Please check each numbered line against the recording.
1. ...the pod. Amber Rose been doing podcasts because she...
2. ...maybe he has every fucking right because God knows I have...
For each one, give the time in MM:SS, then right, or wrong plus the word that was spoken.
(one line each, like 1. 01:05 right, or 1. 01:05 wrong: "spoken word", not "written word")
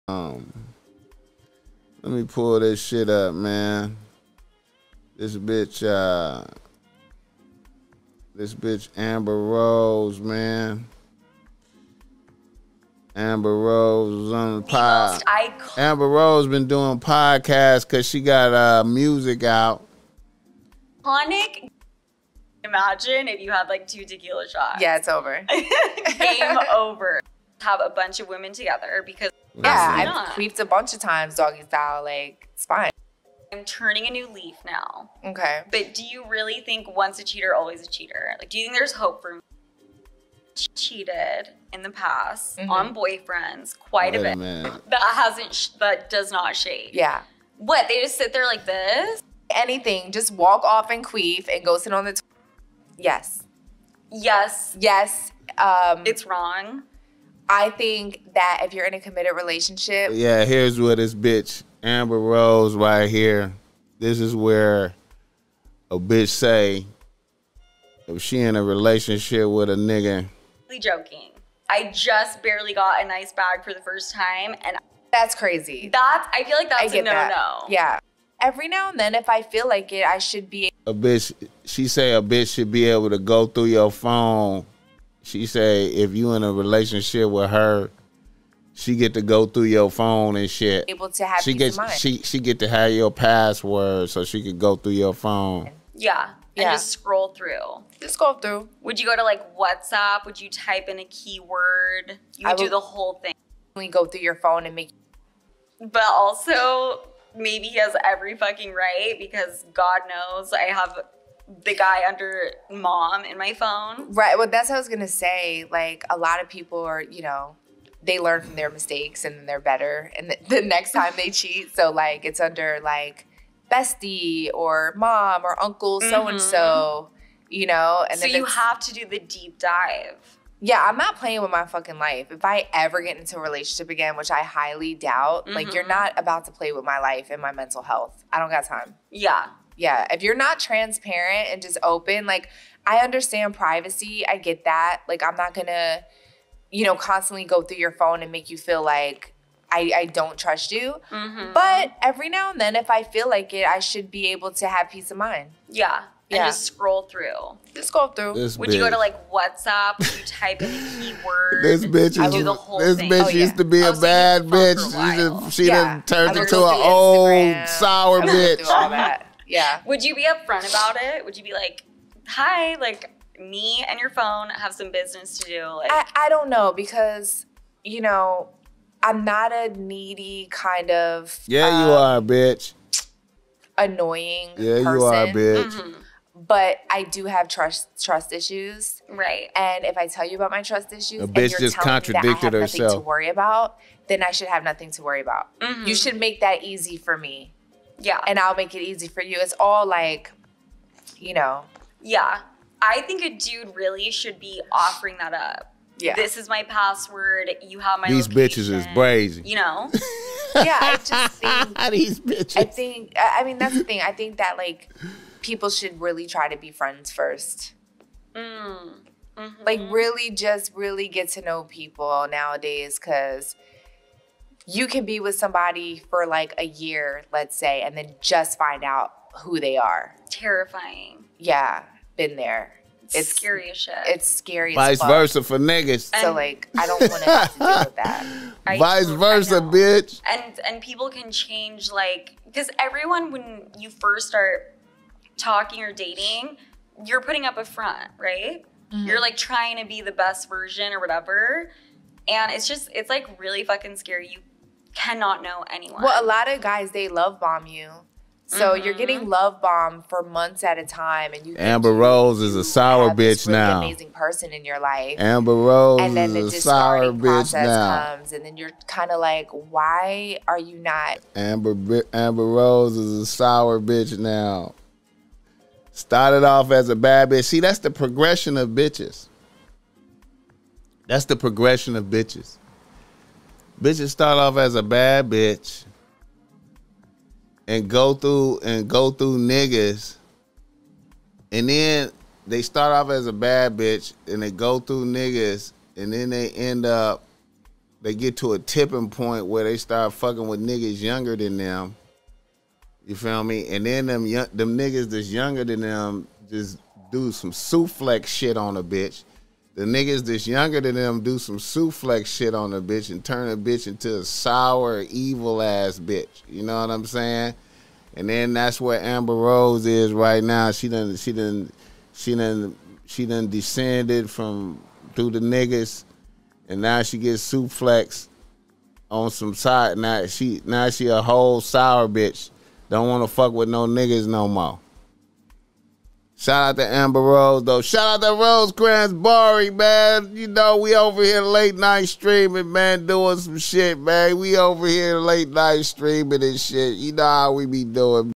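1. 00:14 right
2. 01:47 right.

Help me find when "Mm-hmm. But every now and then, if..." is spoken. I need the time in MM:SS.
02:31.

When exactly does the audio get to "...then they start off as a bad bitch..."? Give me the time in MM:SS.
04:51.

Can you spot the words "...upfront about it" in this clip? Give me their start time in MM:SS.
02:50.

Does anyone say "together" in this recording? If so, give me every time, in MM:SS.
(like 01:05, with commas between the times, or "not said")
00:28.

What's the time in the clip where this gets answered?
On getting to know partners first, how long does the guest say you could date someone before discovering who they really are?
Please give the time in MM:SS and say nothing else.
03:46.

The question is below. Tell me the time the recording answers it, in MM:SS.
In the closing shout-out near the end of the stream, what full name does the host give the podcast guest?
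05:38.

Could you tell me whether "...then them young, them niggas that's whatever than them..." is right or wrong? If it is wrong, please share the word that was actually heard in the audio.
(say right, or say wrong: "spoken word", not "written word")
wrong: "younger", not "whatever".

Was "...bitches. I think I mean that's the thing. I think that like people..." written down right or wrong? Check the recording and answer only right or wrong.
right.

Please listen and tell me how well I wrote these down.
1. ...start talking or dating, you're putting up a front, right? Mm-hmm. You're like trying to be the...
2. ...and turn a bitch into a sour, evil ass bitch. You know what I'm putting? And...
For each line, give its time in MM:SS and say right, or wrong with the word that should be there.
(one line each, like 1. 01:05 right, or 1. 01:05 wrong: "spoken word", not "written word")
1. 04:04 right
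2. 05:13 wrong: "saying", not "putting".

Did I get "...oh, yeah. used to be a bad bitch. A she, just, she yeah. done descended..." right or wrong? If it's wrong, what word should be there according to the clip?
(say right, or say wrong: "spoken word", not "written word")
wrong: "turned", not "descended".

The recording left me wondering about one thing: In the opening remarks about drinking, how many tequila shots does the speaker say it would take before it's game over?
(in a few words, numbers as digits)
2.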